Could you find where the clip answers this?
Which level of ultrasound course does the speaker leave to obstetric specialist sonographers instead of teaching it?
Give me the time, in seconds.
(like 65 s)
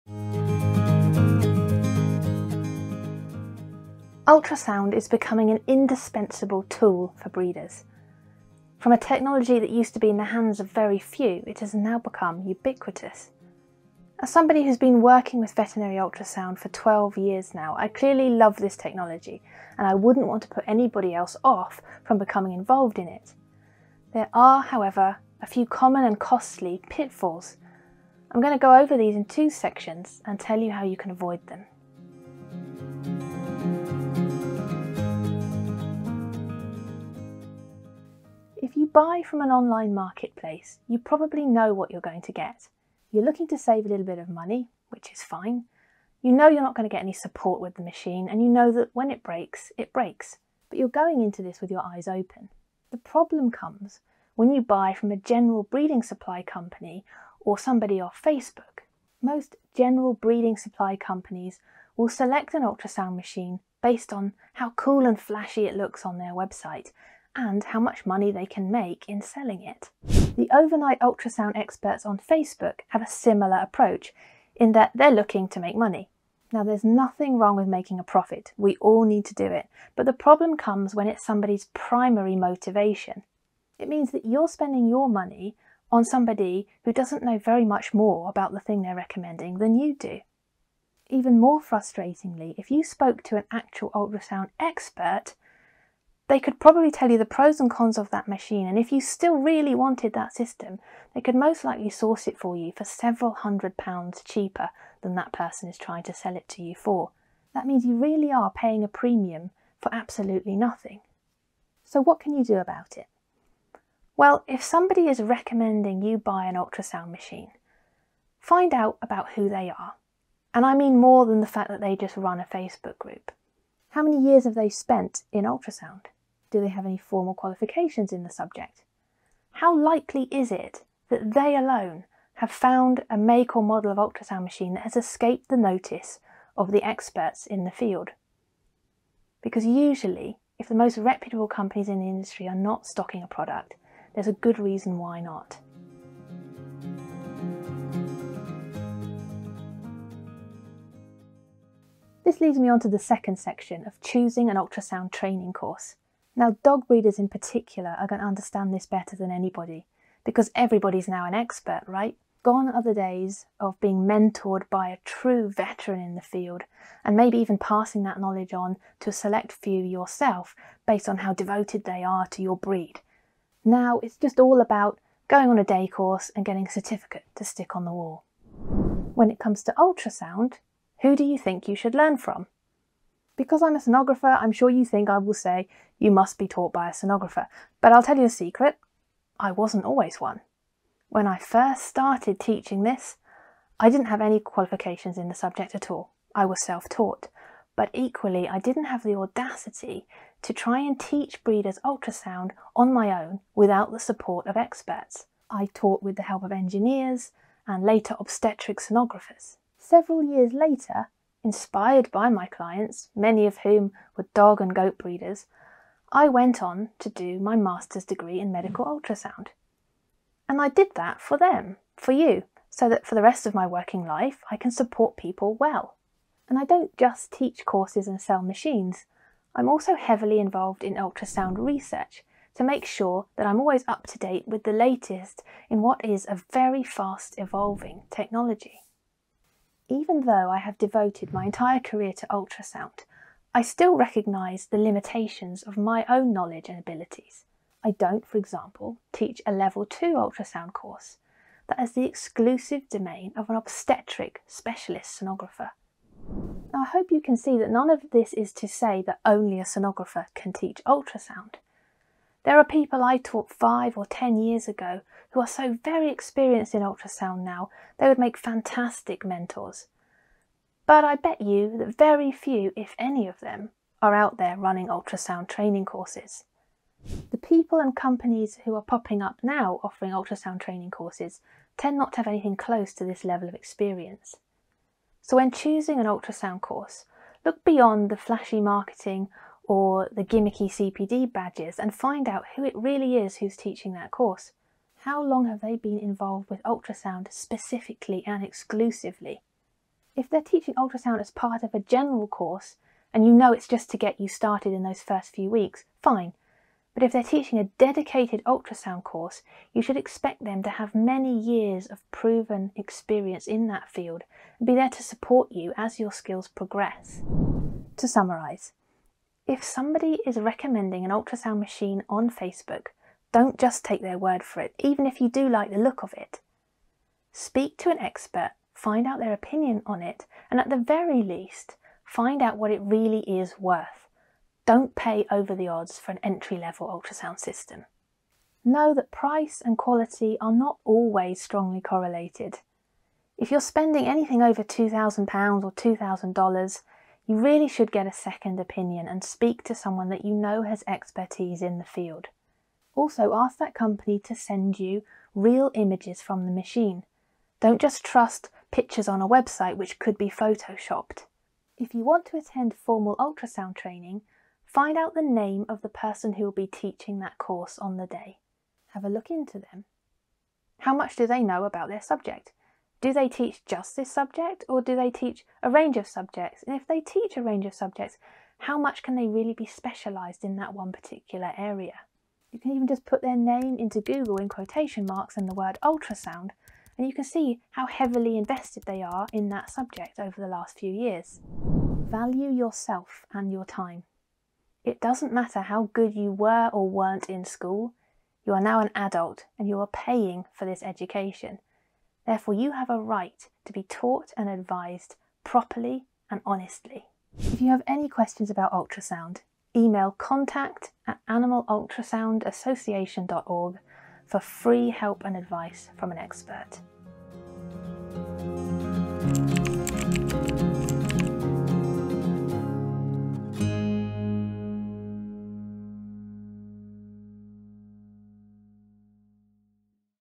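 249 s.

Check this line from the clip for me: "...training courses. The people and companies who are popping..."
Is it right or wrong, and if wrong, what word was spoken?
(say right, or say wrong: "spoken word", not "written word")
right.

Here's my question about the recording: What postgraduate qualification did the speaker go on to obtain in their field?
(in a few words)
master's degree in medical ultrasound.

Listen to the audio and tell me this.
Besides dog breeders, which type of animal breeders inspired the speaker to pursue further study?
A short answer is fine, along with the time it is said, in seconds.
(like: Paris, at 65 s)
goat breeders, at 214 s.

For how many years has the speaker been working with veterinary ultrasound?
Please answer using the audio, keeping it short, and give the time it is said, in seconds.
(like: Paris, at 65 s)
12, at 16 s.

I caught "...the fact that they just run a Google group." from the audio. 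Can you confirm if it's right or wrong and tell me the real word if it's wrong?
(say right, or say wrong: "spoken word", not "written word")
wrong: "Facebook", not "Google".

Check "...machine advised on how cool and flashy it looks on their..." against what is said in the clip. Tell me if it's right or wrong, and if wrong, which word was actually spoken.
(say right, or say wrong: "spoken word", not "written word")
wrong: "based", not "advised".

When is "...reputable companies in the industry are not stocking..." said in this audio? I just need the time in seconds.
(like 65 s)
140 s.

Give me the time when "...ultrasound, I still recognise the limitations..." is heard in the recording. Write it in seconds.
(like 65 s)
242 s.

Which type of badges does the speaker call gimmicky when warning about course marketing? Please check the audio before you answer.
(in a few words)
CPD badges.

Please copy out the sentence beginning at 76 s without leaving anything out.
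Now, there's nothing wrong with making a profit.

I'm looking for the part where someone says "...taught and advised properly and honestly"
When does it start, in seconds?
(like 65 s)
403 s.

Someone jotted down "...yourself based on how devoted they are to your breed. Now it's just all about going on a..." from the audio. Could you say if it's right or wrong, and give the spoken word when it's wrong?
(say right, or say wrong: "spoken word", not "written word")
right.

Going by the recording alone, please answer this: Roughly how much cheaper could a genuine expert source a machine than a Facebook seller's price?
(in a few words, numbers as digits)
several hundred pounds.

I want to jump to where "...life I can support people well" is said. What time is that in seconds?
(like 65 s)
224 s.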